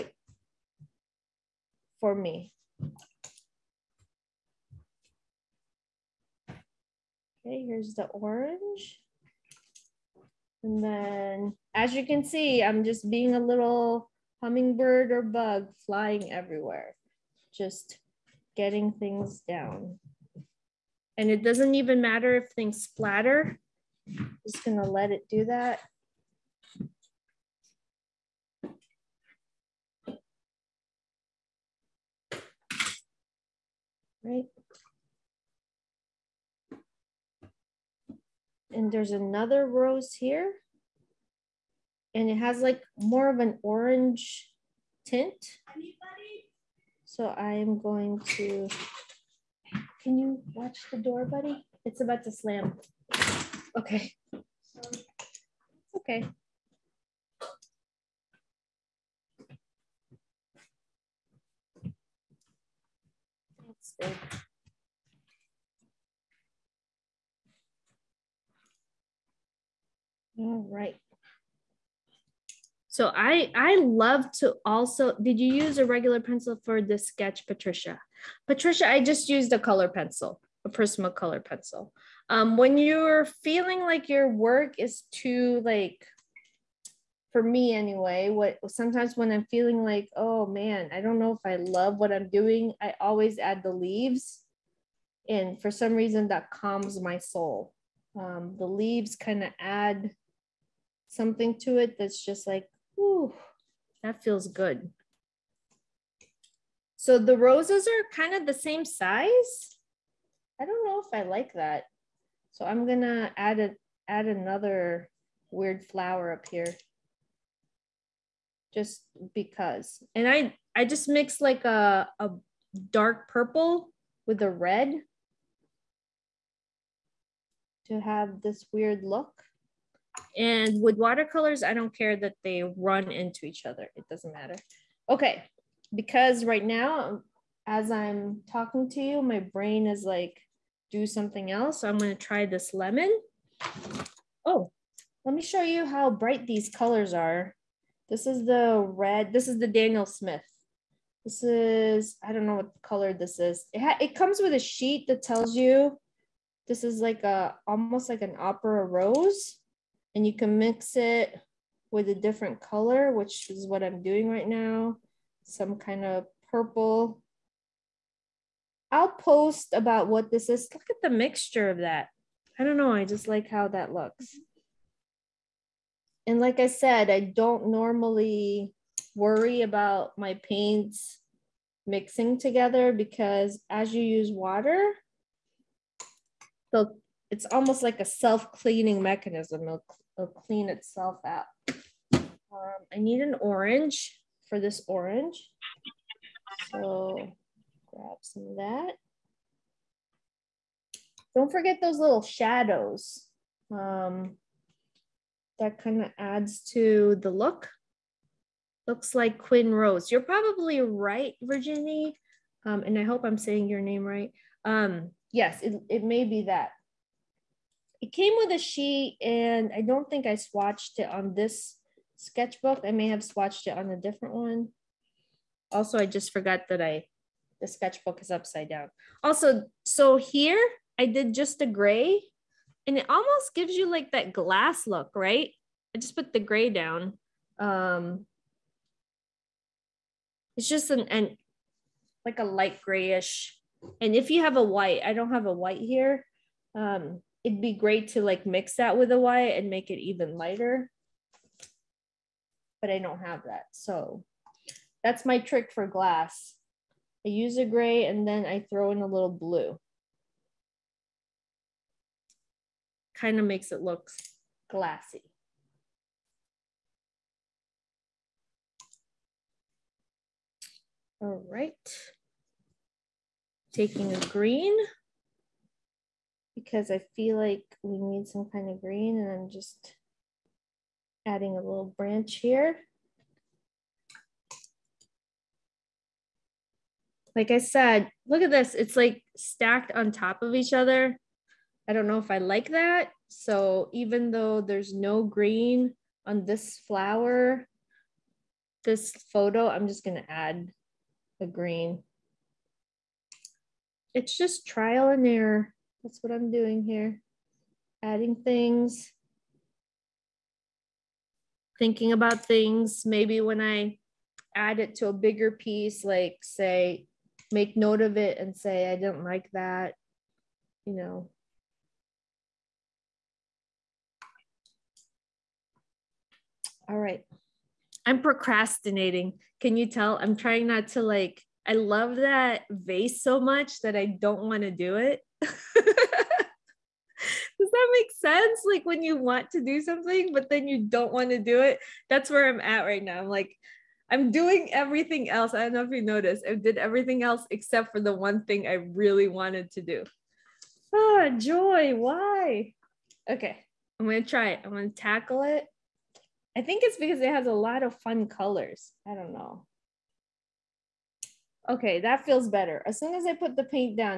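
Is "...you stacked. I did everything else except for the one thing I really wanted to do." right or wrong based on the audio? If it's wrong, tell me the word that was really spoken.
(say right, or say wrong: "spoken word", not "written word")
wrong: "noticed", not "stacked".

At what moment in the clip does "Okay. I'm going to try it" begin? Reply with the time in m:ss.
5:53.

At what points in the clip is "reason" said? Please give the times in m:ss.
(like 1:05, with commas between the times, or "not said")
1:35.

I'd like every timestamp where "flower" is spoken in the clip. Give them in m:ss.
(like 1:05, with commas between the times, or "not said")
1:55, 4:56.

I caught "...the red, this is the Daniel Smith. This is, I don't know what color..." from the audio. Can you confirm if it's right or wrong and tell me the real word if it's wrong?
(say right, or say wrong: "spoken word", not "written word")
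right.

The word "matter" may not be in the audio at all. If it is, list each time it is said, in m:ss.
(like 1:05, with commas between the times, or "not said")
0:22, 2:14.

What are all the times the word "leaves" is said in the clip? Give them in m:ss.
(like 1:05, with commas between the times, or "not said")
1:33, 1:38.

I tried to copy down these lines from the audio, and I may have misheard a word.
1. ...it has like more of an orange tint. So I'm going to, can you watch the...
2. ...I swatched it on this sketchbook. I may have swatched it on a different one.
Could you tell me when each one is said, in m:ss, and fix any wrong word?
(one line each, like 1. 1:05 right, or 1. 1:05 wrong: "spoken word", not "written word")
1. 0:42 right
2. 3:40 right.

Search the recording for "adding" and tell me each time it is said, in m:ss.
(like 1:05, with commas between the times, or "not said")
4:41, 5:08.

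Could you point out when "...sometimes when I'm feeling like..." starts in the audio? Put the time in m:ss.
1:28.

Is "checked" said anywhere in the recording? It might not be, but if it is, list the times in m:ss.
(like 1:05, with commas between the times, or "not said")
not said.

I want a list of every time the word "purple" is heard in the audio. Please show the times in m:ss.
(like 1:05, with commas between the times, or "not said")
2:03, 2:46.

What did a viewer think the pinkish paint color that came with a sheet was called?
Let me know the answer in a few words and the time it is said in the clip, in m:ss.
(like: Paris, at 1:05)
Quin Rose, at 3:29.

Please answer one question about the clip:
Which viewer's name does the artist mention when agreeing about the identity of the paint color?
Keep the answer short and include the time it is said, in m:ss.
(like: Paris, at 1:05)
Virginie, at 3:31.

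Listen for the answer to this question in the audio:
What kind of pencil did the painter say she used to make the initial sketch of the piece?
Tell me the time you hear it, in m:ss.
1:20.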